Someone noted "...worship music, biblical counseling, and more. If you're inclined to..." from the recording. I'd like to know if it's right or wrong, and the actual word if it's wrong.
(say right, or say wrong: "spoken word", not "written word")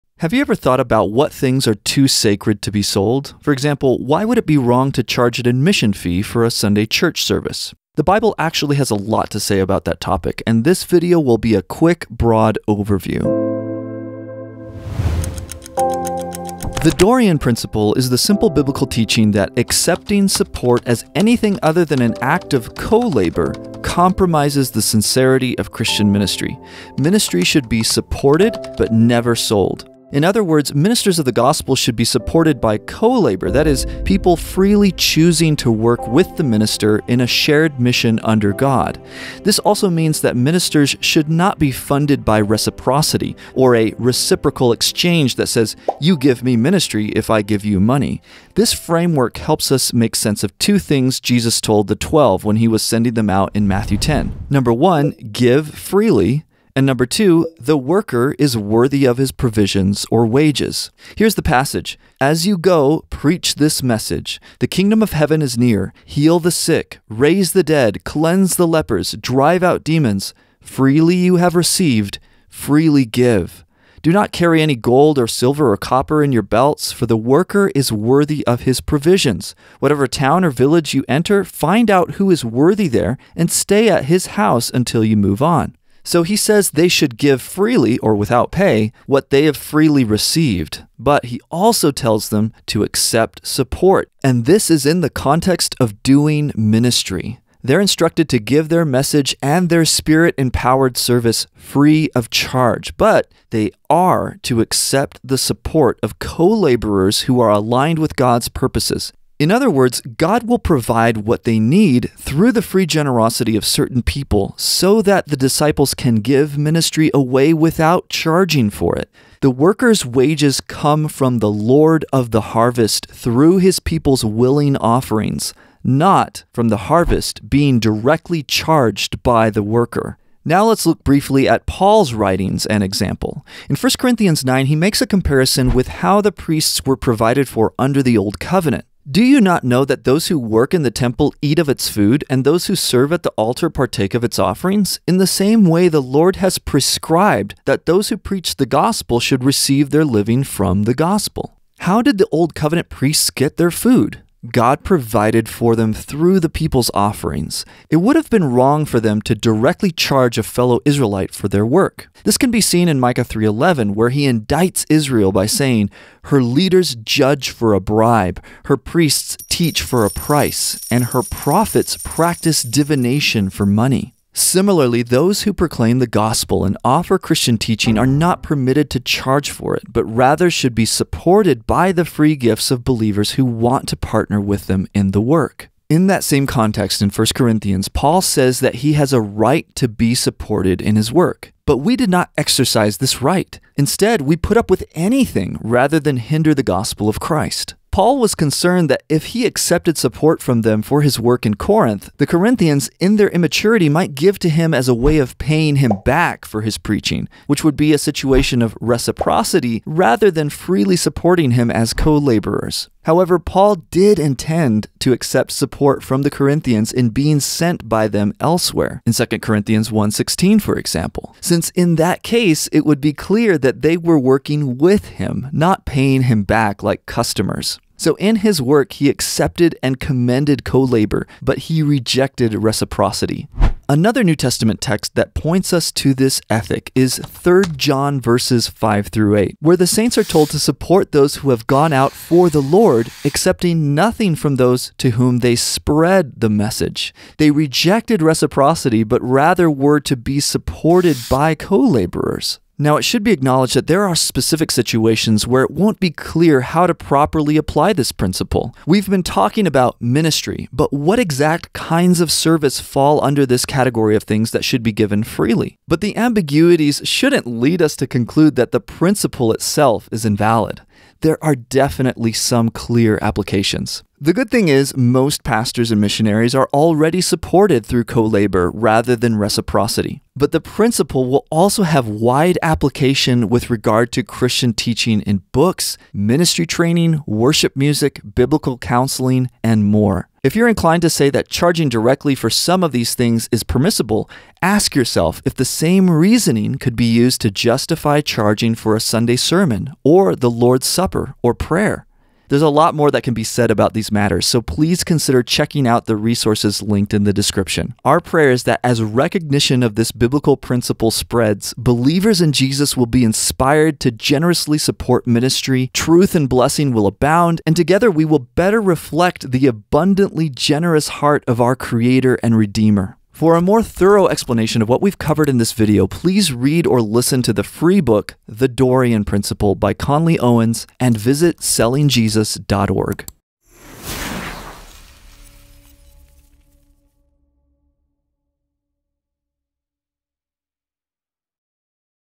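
right.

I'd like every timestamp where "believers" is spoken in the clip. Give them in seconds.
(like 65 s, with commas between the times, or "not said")
182 s, 311 s.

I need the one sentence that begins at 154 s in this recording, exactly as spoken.
God provided for them through the people's offerings.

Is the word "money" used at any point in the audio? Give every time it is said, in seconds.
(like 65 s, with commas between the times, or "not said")
47 s, 173 s.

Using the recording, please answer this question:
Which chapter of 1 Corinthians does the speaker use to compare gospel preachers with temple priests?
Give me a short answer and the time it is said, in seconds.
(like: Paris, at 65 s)
Chapter 9, at 133 s.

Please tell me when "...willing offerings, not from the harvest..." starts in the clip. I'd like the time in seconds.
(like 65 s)
124 s.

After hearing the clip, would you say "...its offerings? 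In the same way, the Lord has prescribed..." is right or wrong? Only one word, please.
right.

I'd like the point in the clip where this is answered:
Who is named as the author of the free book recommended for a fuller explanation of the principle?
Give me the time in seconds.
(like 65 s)
329 s.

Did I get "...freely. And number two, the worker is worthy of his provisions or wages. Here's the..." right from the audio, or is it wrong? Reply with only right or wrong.
right.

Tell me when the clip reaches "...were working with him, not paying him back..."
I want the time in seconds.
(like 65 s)
223 s.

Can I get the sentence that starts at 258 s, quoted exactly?
We've been talking about ministry, but what exact kinds of service fall under this category of things that should be given freely?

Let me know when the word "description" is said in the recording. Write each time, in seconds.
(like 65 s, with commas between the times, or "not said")
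307 s.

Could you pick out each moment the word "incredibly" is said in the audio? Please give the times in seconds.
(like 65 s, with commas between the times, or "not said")
not said.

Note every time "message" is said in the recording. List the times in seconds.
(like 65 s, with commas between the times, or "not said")
63 s, 98 s, 246 s.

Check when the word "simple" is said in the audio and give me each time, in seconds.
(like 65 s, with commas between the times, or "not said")
18 s.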